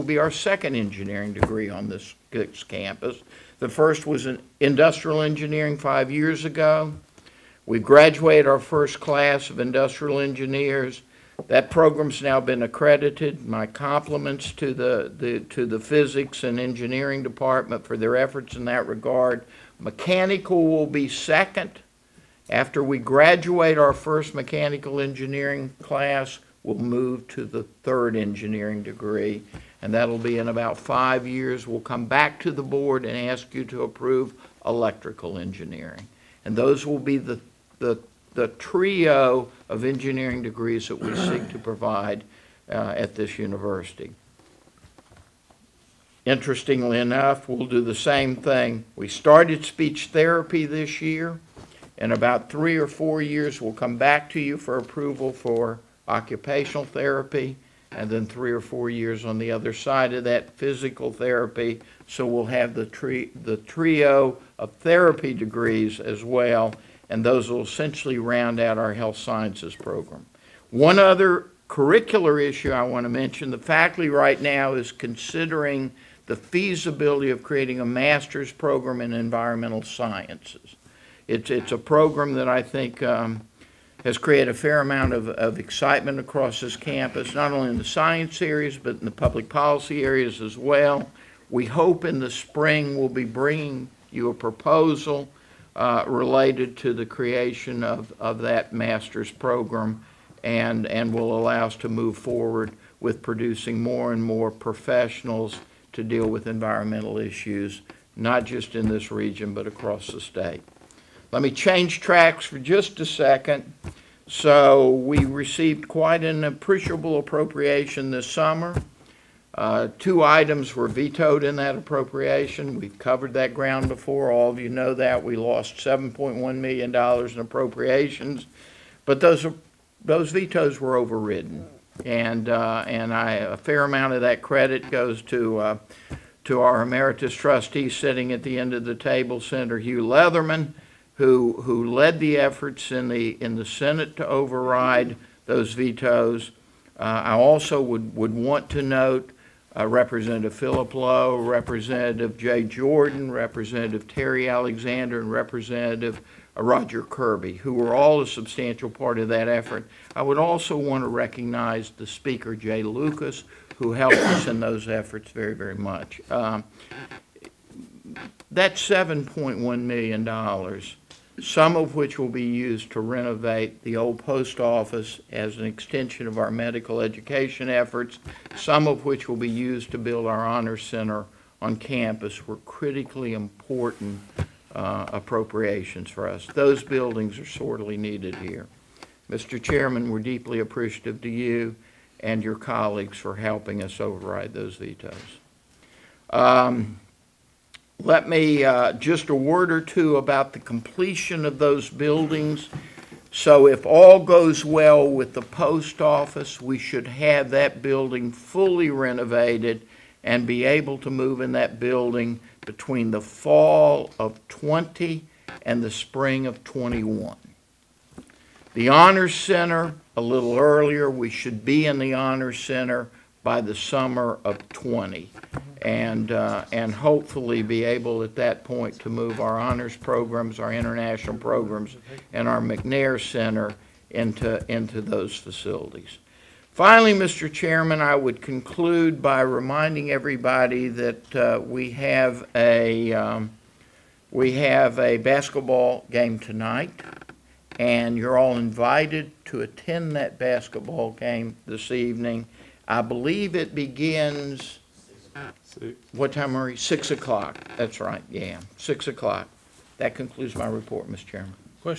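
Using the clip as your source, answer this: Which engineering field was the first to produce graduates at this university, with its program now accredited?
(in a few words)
Industrial engineering.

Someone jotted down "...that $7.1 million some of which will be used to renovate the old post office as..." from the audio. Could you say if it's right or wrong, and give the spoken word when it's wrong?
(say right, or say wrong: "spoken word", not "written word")
right.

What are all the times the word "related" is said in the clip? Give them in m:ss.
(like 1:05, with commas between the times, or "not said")
1:36.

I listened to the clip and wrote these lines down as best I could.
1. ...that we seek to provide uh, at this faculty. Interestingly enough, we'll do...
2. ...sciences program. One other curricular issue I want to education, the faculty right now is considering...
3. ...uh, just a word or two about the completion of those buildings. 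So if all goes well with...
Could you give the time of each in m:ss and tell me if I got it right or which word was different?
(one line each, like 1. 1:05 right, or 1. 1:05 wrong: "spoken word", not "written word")
1. 0:40 wrong: "university", not "faculty"
2. 1:09 wrong: "mention", not "education"
3. 3:18 right.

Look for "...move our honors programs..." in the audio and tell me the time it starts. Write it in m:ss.
3:49.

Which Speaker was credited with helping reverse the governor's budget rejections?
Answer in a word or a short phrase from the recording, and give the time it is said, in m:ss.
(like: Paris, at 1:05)
Jay Lucas, at 2:42.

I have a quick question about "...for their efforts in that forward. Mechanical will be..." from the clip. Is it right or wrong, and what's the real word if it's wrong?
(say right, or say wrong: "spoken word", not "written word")
wrong: "regard", not "forward".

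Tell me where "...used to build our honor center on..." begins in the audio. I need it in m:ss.
2:59.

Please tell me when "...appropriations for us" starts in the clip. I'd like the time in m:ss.
3:05.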